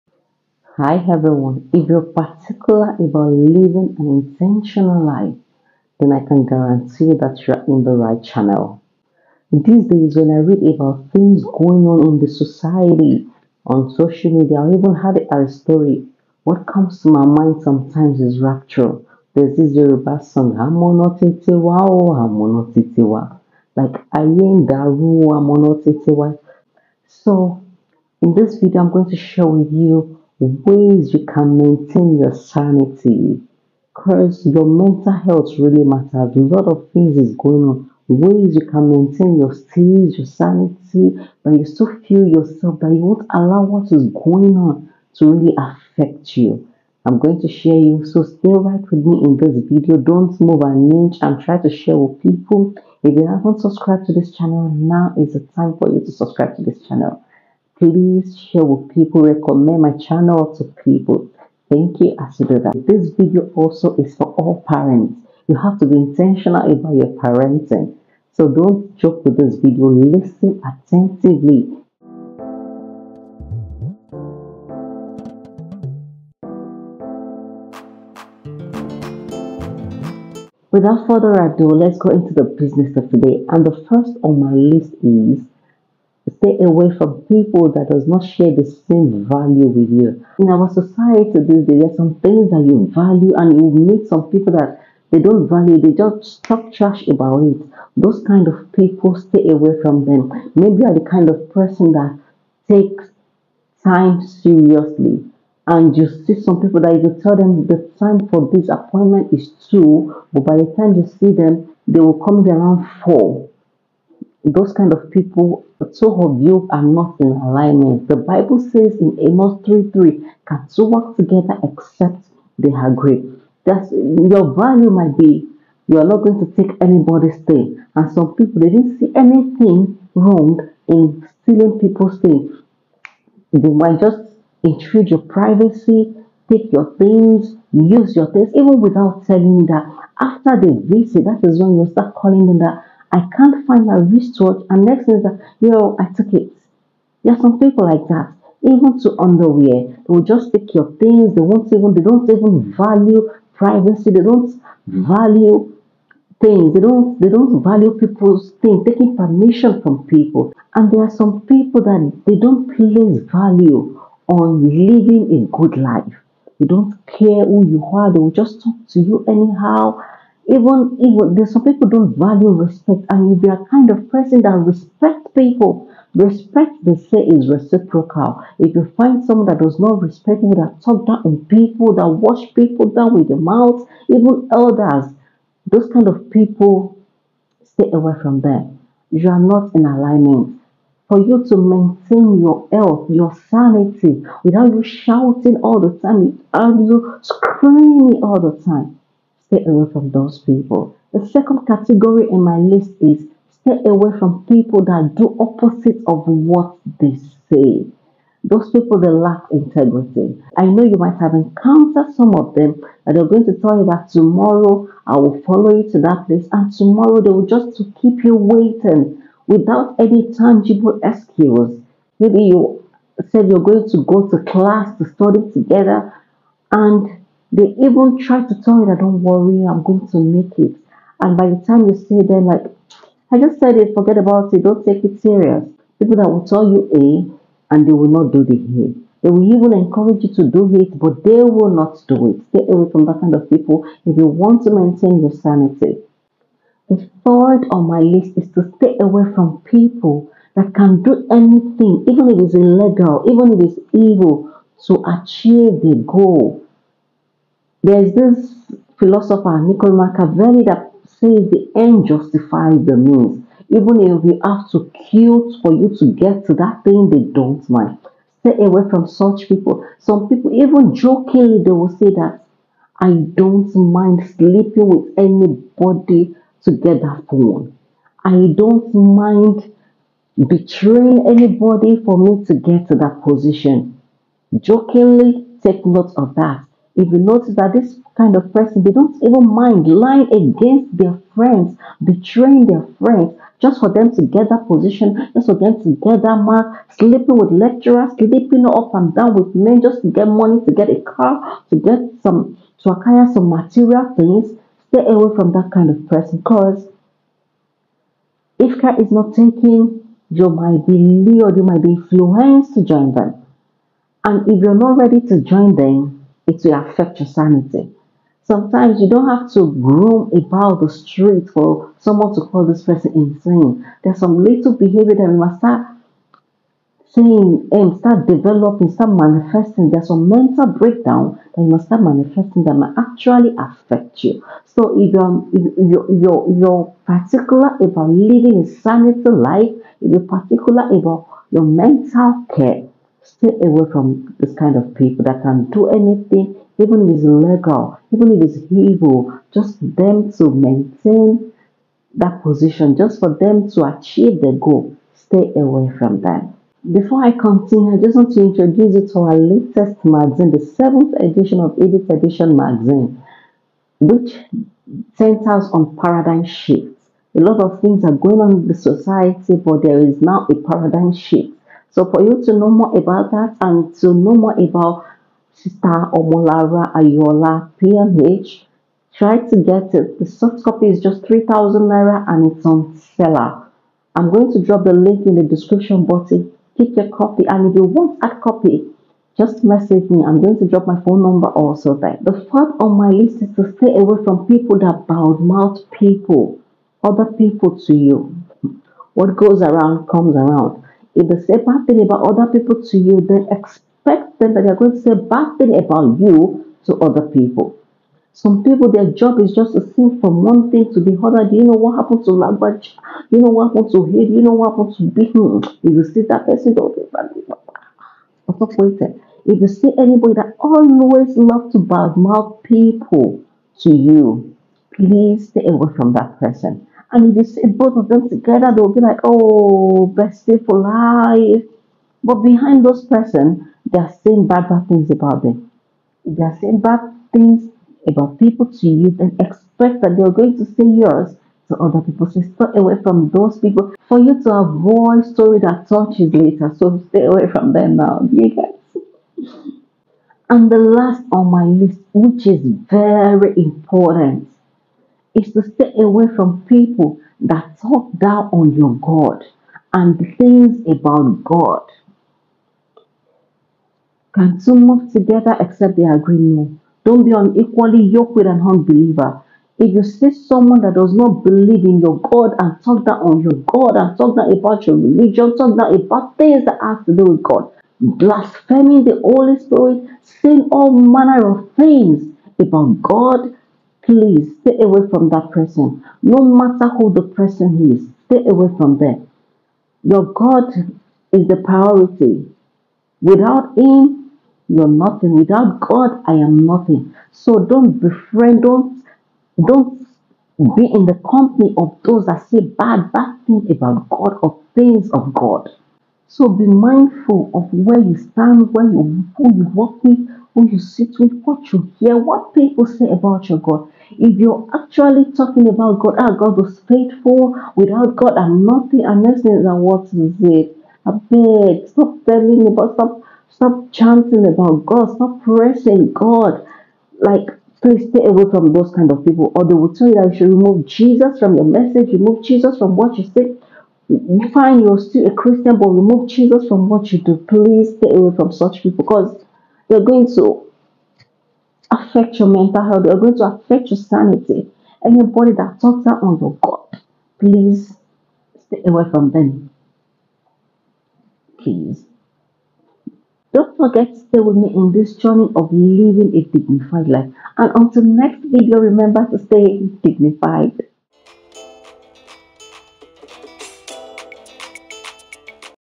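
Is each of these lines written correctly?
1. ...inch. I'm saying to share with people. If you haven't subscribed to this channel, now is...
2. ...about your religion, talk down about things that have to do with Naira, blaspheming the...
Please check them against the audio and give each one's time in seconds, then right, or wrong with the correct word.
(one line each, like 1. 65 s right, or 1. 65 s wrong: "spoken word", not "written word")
1. 50 s wrong: "trying", not "saying"
2. 474 s wrong: "God", not "Naira".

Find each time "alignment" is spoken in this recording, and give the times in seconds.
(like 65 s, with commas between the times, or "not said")
117 s, 189 s.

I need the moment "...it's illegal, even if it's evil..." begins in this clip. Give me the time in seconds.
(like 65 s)
252 s.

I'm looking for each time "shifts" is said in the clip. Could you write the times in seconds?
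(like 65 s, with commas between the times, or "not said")
366 s, 371 s.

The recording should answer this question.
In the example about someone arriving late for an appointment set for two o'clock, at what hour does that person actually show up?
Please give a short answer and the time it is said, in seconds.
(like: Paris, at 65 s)
4, at 113 s.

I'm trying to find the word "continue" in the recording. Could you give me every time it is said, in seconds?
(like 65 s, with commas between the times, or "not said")
357 s.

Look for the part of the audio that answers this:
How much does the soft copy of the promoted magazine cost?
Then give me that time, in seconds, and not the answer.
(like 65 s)
381 s.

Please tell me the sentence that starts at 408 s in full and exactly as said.
Some people, their job is just to sing from one thing to the other.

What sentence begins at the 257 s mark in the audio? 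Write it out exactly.
There's this philosopher, Niccolò Machiavelli, that says the end justifies the means.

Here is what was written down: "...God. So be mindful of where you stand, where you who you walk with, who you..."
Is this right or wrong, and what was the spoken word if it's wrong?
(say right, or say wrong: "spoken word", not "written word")
right.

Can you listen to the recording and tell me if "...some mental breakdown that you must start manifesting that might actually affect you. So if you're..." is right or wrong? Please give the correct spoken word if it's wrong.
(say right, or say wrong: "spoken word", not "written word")
right.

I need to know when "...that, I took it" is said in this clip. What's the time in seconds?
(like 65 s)
145 s.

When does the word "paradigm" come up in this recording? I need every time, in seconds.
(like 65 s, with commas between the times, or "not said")
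365 s, 370 s.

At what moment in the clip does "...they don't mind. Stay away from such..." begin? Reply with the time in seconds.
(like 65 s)
267 s.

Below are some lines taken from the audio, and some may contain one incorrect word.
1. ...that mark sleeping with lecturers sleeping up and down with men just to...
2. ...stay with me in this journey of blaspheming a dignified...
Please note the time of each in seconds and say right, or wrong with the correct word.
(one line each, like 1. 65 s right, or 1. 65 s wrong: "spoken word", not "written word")
1. 296 s right
2. 554 s wrong: "living", not "blaspheming".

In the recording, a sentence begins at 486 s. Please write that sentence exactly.
No matter who the person is, stay away from them.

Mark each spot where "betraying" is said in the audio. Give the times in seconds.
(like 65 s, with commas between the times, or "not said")
280 s, 292 s.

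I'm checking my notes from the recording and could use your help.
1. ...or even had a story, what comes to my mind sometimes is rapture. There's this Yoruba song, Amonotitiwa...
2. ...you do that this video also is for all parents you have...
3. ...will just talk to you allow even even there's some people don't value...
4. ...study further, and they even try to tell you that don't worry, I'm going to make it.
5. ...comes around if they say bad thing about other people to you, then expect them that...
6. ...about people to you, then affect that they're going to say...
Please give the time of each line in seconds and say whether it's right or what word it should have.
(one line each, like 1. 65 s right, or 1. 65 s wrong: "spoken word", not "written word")
1. 14 s right
2. 62 s right
3. 168 s wrong: "anyhow", not "allow"
4. 225 s wrong: "together", not "further"
5. 400 s right
6. 438 s wrong: "expect", not "affect".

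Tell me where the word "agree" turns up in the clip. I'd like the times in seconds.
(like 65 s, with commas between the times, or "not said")
122 s, 466 s.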